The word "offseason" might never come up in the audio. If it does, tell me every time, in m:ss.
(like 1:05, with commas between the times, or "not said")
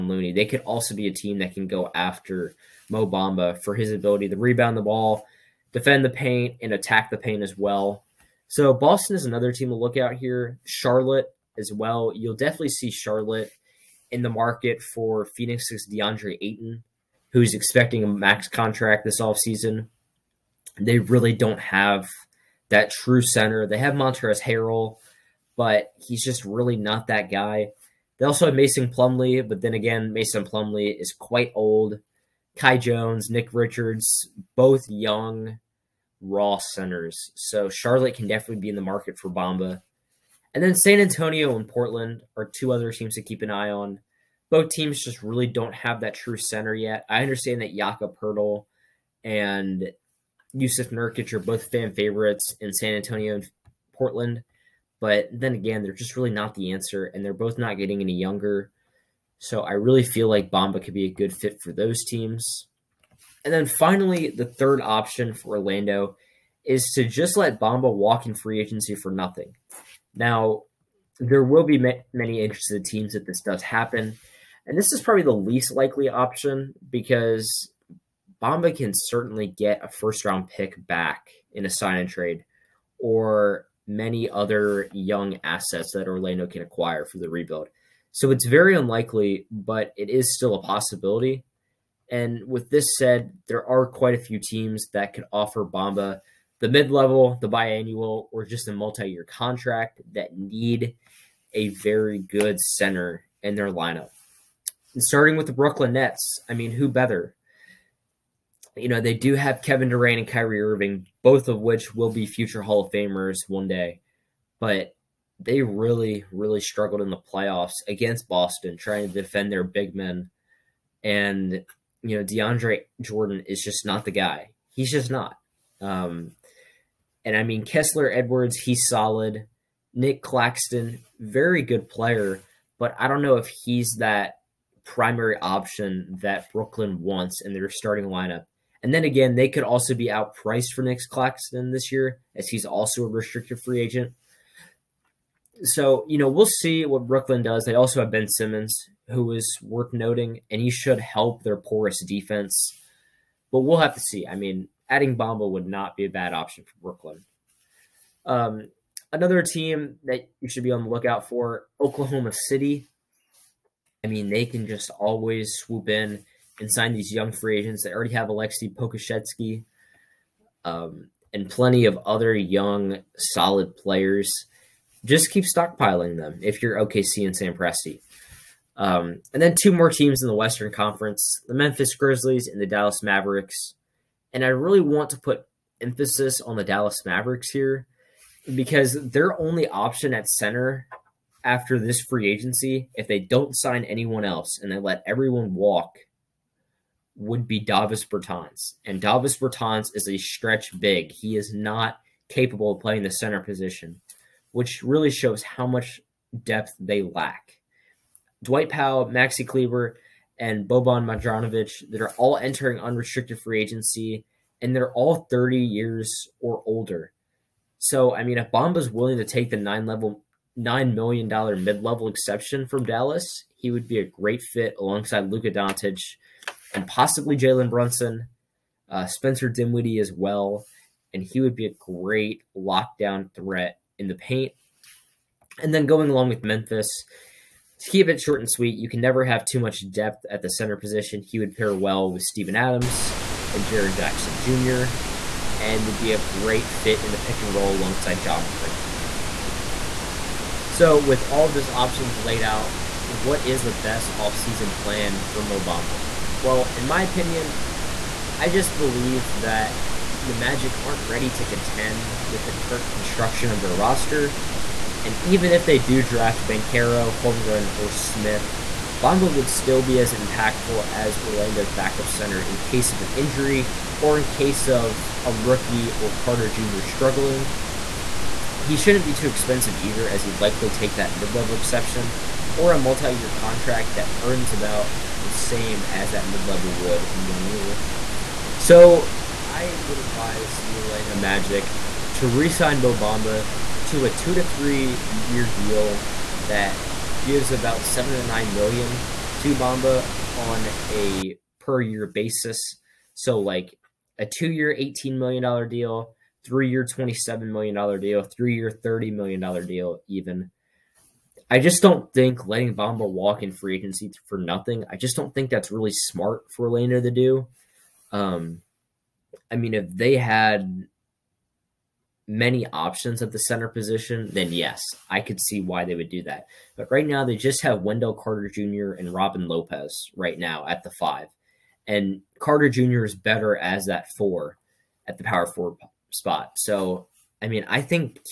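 0:19, 4:14.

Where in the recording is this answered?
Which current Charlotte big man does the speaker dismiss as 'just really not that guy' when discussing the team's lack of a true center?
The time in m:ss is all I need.
0:23.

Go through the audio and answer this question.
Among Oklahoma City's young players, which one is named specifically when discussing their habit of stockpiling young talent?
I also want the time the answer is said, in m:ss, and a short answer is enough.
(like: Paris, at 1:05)
Aleksej Pokusevski, at 2:48.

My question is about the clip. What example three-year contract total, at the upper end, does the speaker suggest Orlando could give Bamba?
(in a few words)
$30 million.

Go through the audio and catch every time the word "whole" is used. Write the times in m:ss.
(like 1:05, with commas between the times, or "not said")
not said.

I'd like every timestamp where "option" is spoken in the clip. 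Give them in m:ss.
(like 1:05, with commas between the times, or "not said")
1:04, 1:16, 2:15, 2:36, 3:09, 4:11, 5:22.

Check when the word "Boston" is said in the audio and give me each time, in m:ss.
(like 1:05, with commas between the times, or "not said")
0:08, 1:58.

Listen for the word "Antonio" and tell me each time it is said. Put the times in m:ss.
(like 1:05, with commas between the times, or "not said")
0:40, 0:52.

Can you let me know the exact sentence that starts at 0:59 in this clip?
So I really feel like Bamba could be a good fit for those teams.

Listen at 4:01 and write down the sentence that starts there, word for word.
He would pair well with Steven Adams and Jaren Jackson Jr.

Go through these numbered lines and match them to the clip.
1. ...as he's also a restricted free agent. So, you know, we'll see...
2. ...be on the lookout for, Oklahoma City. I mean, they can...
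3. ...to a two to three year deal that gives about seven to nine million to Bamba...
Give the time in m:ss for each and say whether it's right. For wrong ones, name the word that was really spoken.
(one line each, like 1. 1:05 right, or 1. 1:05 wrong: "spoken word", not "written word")
1. 2:22 right
2. 2:40 right
3. 4:53 right.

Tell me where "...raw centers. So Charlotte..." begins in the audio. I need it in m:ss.
0:36.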